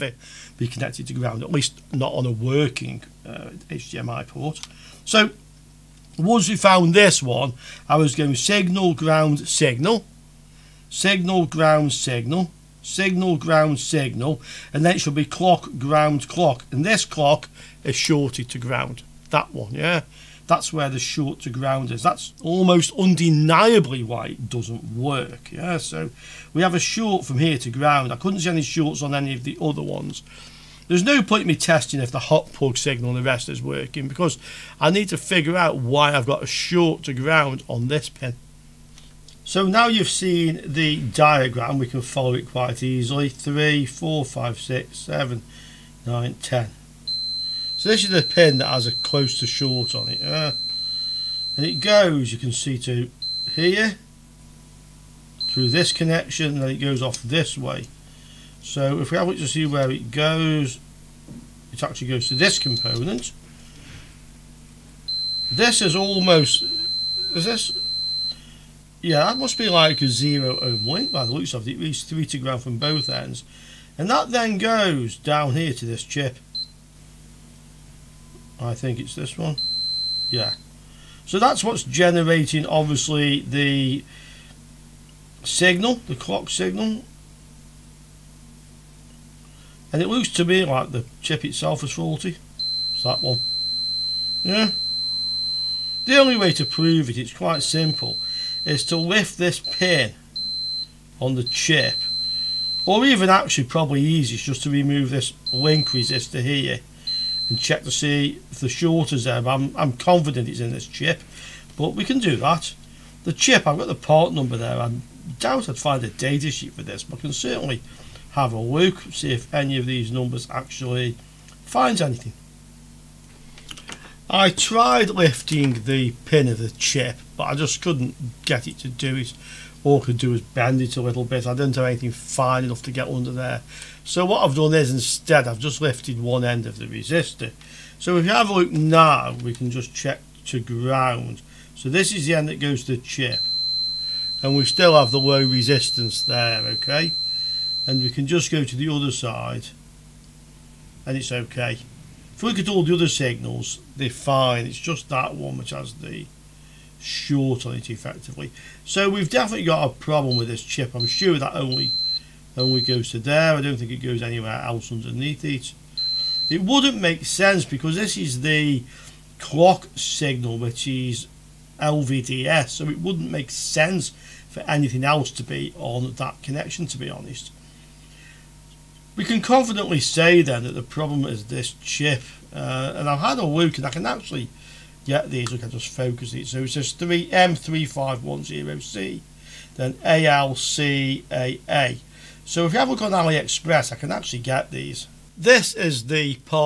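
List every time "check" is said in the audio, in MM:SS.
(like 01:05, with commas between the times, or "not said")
01:47, 02:19.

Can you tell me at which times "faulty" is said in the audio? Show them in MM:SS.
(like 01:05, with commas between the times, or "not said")
01:31.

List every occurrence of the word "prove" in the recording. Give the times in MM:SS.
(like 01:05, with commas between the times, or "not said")
01:36.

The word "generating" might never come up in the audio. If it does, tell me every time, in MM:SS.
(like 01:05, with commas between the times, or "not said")
01:21.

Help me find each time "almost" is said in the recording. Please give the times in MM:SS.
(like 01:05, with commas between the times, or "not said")
00:22, 01:05.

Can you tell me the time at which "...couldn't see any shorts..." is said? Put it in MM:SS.
00:28.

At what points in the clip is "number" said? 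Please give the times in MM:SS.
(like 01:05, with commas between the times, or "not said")
01:54, 02:00.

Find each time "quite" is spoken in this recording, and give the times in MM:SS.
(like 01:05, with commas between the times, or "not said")
00:42, 01:37.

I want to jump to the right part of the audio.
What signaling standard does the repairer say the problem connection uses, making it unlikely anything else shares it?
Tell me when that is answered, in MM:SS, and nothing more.
02:51.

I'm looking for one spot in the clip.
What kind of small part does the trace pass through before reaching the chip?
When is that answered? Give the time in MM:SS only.
01:10.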